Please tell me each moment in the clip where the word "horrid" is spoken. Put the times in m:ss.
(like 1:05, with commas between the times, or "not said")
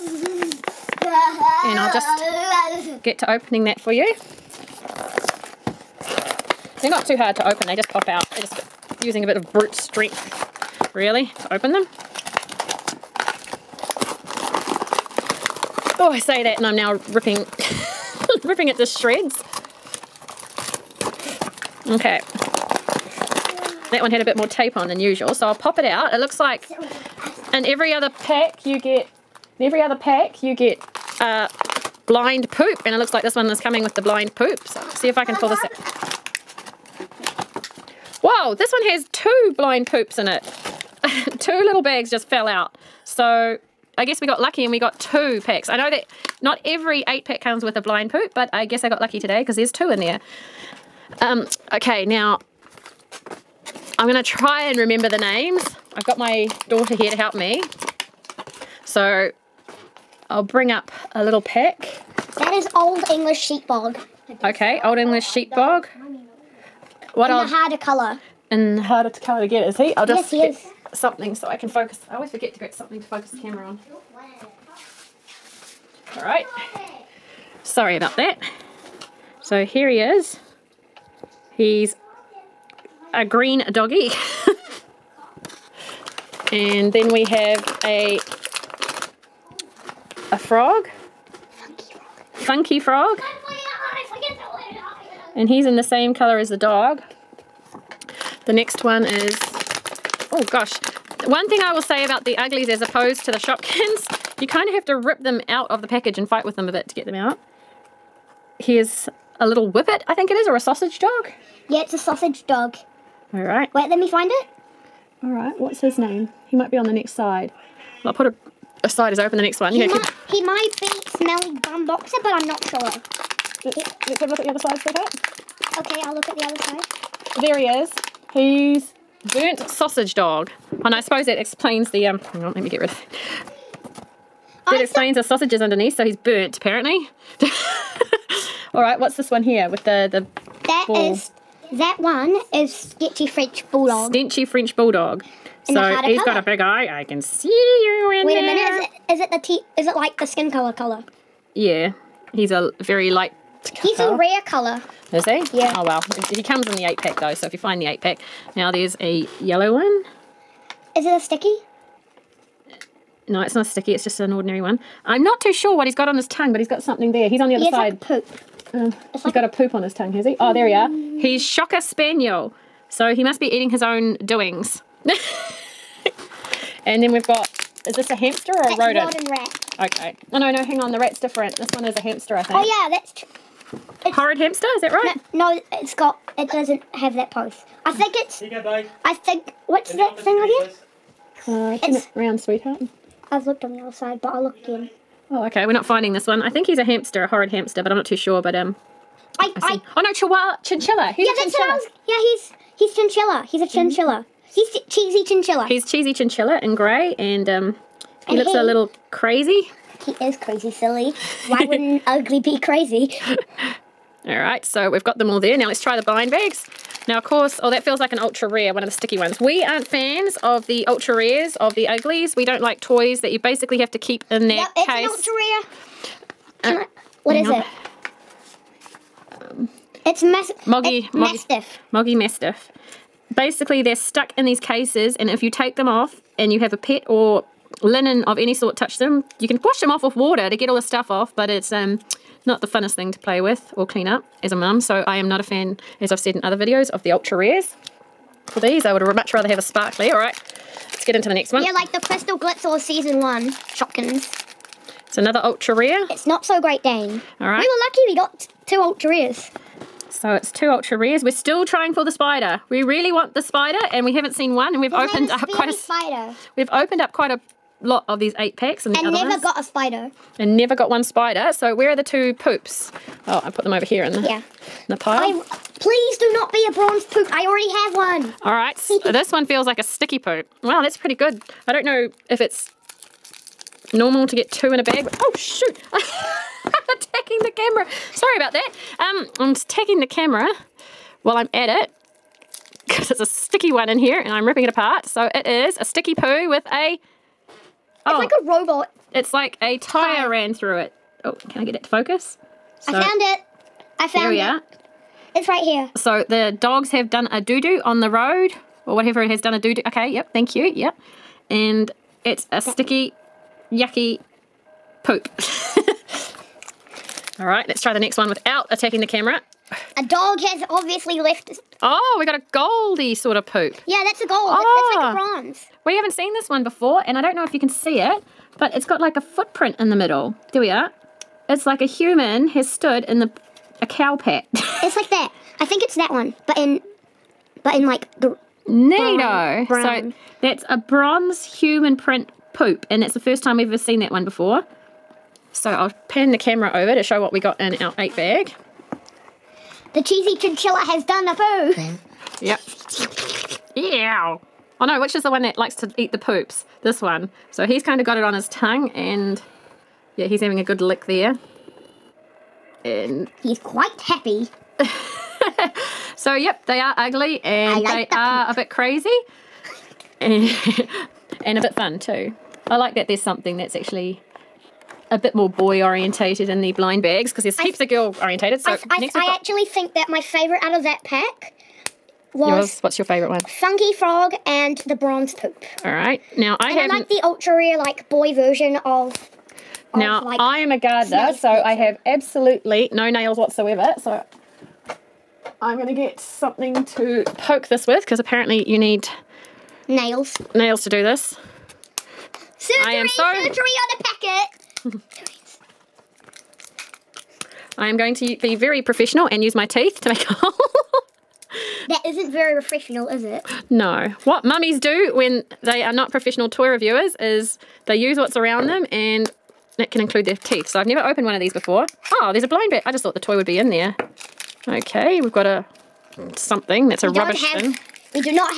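3:04, 3:17.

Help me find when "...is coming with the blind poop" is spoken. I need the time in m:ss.
0:33.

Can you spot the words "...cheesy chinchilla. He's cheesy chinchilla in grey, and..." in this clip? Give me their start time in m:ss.
3:24.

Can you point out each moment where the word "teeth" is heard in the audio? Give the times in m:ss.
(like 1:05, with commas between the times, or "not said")
6:49, 7:00.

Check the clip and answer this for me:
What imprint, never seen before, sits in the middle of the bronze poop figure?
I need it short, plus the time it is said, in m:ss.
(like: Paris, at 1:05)
A footprint, at 5:28.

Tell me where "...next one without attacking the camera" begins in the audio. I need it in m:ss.
5:17.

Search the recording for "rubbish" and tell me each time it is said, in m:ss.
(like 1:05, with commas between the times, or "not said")
7:07.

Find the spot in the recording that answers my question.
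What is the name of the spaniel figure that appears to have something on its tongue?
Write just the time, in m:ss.
2:50.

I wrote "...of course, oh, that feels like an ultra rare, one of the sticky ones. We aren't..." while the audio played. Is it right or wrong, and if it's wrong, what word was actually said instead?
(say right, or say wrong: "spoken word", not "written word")
right.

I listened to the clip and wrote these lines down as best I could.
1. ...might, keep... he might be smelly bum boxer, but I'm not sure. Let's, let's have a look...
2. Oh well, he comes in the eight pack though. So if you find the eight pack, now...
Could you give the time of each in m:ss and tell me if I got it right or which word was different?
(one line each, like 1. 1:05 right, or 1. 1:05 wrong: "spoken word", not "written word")
1. 1:59 right
2. 2:35 right.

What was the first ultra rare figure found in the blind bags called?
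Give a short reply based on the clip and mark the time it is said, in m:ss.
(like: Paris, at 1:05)
Moggy Mastiff, at 3:51.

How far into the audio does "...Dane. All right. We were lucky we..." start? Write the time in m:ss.
4:16.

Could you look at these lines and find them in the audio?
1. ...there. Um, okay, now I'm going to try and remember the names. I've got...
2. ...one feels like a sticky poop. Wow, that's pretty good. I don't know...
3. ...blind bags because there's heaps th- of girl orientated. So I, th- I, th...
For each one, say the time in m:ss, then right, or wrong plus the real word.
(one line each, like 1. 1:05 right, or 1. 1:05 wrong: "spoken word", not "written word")
1. 0:50 right
2. 4:39 right
3. 6:16 right.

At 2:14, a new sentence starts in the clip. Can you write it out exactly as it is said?
That I explains the sausages underneath, so he's burnt, apparently.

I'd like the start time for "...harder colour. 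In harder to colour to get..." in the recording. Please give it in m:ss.
1:07.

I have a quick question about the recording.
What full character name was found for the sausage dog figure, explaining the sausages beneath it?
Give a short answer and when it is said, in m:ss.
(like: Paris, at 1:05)
Burnt Sausage Dog, at 2:08.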